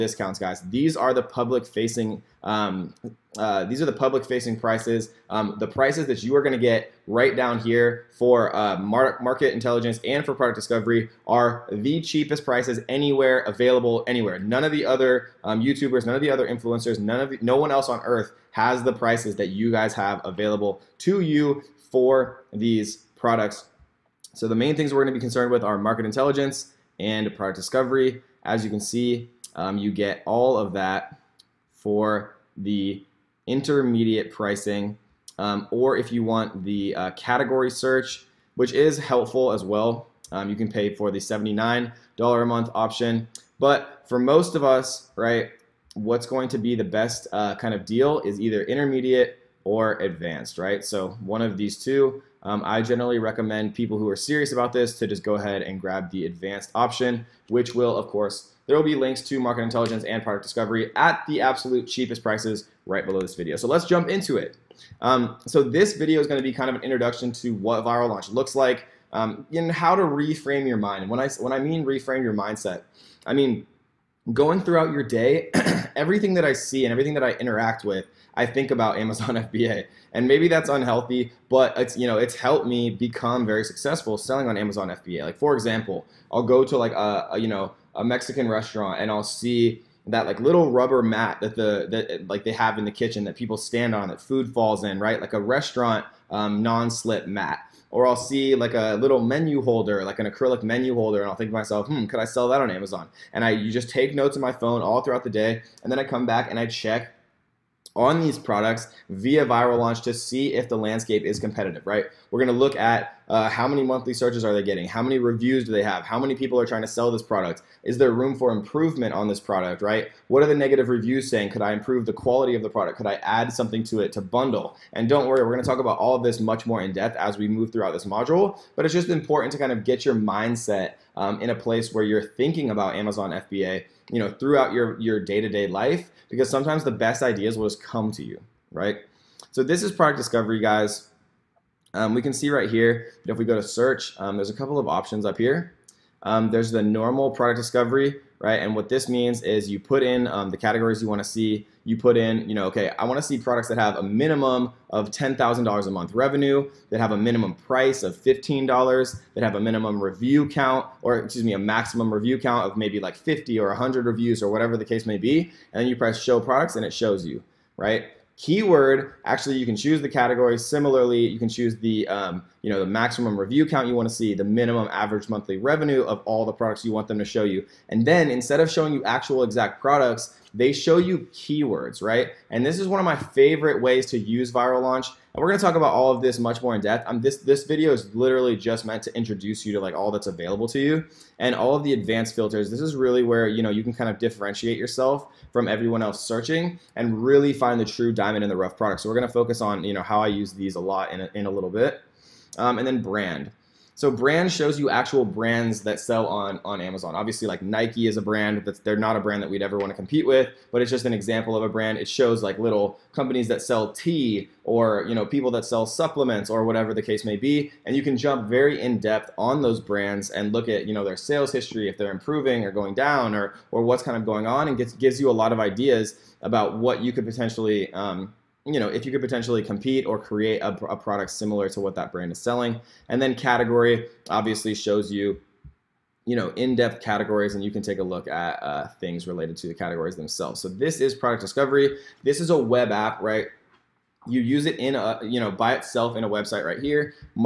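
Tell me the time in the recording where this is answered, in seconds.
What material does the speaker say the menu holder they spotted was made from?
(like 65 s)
100 s.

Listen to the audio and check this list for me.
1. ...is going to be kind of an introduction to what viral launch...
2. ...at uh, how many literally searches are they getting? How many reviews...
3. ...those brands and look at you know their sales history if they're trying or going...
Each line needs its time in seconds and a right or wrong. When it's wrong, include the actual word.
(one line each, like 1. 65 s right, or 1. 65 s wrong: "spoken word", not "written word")
1. 66 s right
2. 112 s wrong: "monthly", not "literally"
3. 219 s wrong: "improving", not "trying".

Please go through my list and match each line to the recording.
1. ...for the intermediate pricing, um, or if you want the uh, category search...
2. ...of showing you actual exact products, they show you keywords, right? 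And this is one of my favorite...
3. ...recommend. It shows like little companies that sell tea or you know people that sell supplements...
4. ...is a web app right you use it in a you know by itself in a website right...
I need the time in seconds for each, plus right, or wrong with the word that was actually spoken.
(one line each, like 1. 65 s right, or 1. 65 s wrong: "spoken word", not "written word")
1. 31 s right
2. 178 s right
3. 211 s wrong: "brand", not "recommend"
4. 242 s right.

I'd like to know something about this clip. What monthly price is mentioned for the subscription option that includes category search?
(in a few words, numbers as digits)
$79.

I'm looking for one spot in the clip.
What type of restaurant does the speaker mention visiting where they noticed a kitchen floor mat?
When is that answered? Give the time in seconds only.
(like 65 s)
88 s.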